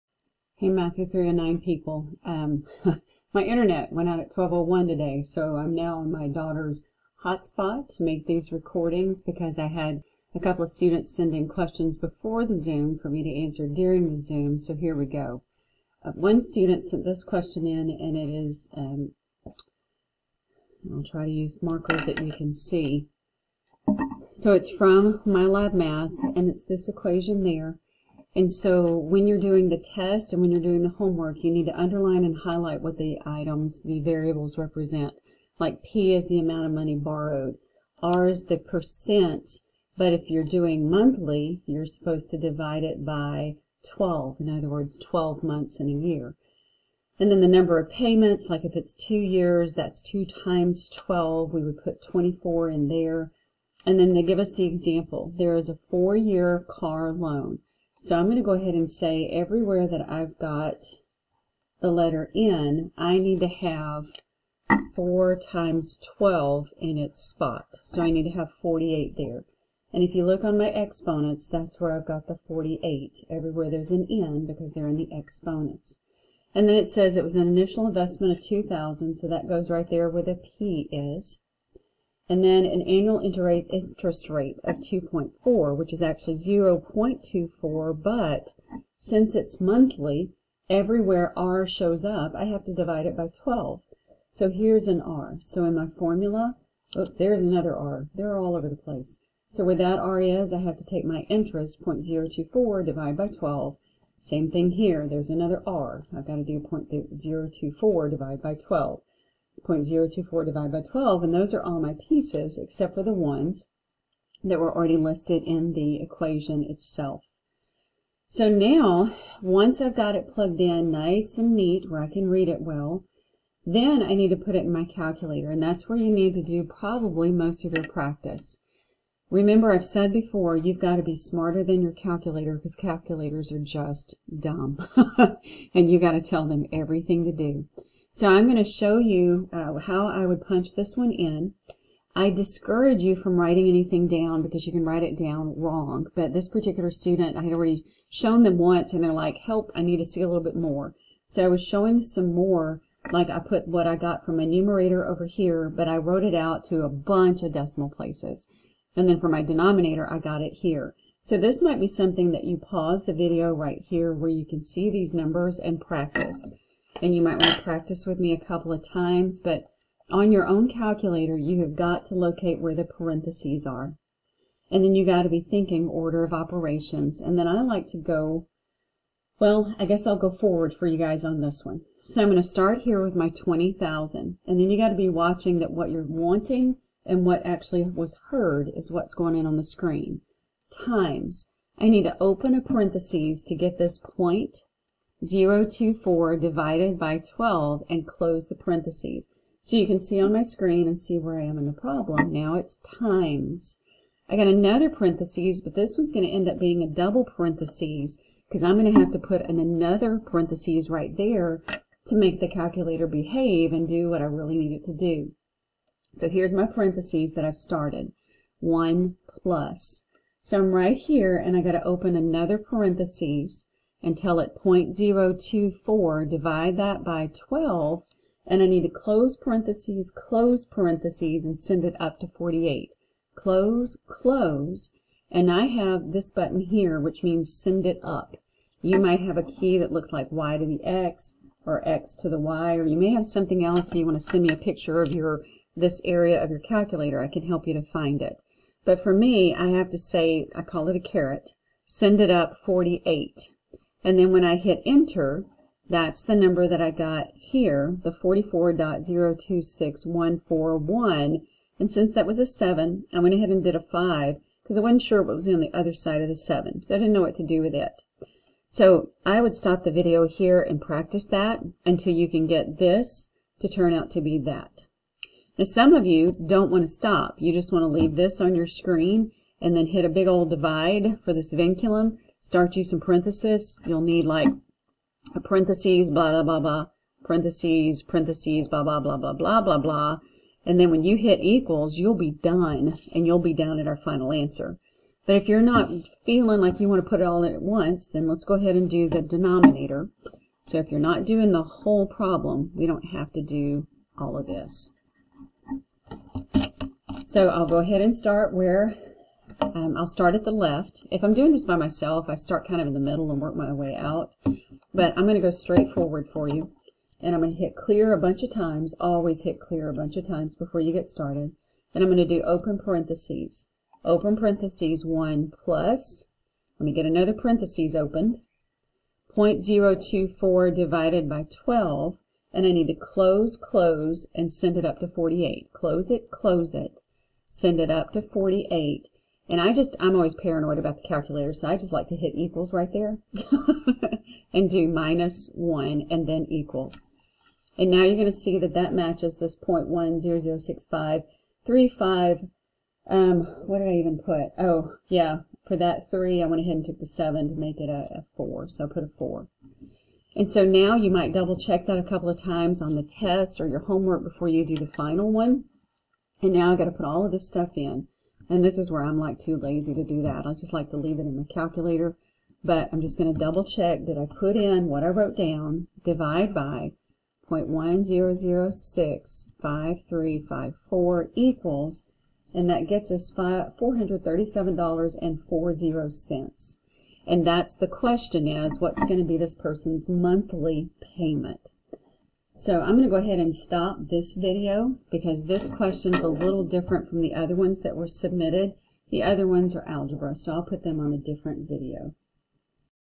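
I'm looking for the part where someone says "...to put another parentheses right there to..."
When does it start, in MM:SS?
03:29.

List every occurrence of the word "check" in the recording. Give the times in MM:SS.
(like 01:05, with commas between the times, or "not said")
06:01, 06:13.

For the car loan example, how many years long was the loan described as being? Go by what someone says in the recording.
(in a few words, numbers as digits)
4.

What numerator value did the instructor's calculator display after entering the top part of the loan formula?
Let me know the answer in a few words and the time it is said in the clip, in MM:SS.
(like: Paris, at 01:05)
44.026141, at 04:18.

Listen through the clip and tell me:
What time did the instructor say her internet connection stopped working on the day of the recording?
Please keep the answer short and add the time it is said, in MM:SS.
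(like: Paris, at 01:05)
12:01, at 00:04.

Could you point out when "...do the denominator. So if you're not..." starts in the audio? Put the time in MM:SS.
04:58.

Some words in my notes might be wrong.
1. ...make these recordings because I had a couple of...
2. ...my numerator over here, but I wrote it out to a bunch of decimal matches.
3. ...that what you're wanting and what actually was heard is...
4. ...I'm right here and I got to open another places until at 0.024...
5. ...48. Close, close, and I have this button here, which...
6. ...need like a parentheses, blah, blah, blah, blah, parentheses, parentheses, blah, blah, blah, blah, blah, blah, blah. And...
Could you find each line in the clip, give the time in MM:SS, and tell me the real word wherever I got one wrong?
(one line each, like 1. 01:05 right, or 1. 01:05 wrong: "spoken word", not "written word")
1. 00:08 right
2. 02:34 wrong: "places", not "matches"
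3. 03:05 right
4. 03:40 wrong: "parentheses", not "places"
5. 03:52 right
6. 04:44 right.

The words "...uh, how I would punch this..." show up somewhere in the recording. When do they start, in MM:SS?
02:19.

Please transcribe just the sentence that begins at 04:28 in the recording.
So I would stop the video here and practice that until you can get this to turn out to be that.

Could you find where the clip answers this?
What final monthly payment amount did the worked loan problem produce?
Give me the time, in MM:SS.
06:23.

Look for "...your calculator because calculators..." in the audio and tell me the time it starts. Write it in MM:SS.
02:11.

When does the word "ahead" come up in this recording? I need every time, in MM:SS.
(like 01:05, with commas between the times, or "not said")
00:58, 04:23, 04:58, 05:07, 05:56, 06:33.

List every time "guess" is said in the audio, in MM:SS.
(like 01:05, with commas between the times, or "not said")
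02:59.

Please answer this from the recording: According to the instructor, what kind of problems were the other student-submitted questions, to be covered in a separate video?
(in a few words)
algebra.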